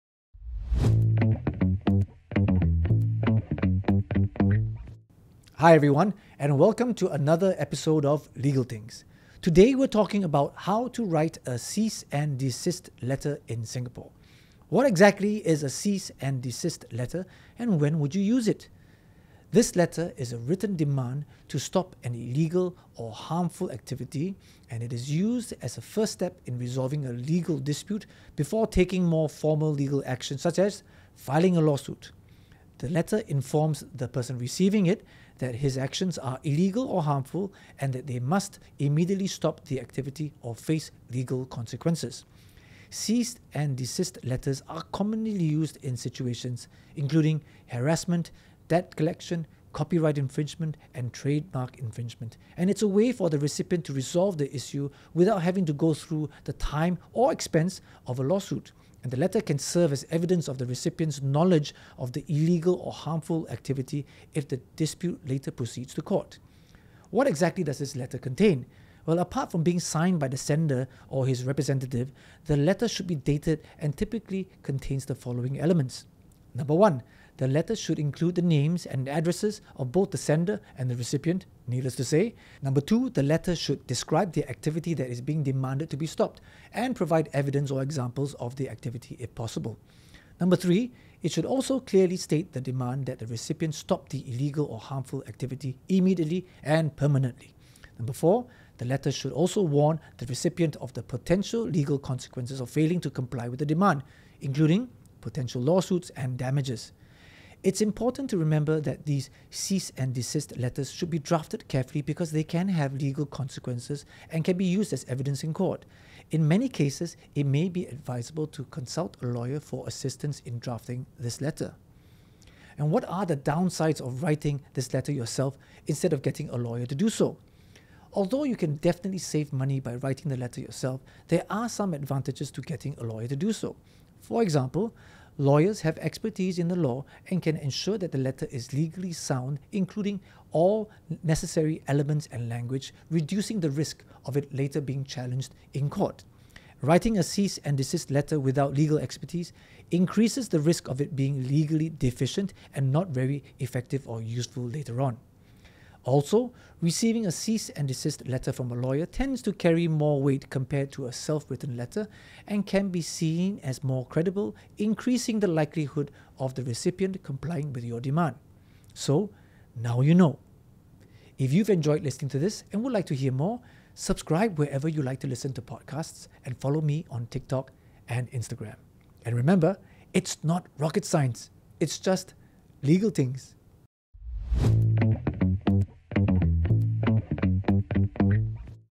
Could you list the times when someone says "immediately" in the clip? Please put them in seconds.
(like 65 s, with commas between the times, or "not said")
38 s, 95 s.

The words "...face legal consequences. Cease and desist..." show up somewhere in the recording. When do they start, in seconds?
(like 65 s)
40 s.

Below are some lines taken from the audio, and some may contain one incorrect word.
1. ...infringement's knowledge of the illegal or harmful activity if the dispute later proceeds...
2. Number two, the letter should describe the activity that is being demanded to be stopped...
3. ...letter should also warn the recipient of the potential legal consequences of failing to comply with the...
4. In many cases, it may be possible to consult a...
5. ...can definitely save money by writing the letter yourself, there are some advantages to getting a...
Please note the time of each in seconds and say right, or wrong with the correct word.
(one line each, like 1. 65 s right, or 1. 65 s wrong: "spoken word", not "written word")
1. 60 s wrong: "recipient", not "infringement"
2. 82 s right
3. 98 s right
4. 116 s wrong: "advisable", not "possible"
5. 128 s right.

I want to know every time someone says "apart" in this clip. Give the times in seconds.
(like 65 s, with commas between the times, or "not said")
69 s.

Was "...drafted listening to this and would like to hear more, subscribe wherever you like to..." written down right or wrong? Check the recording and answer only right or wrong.
wrong.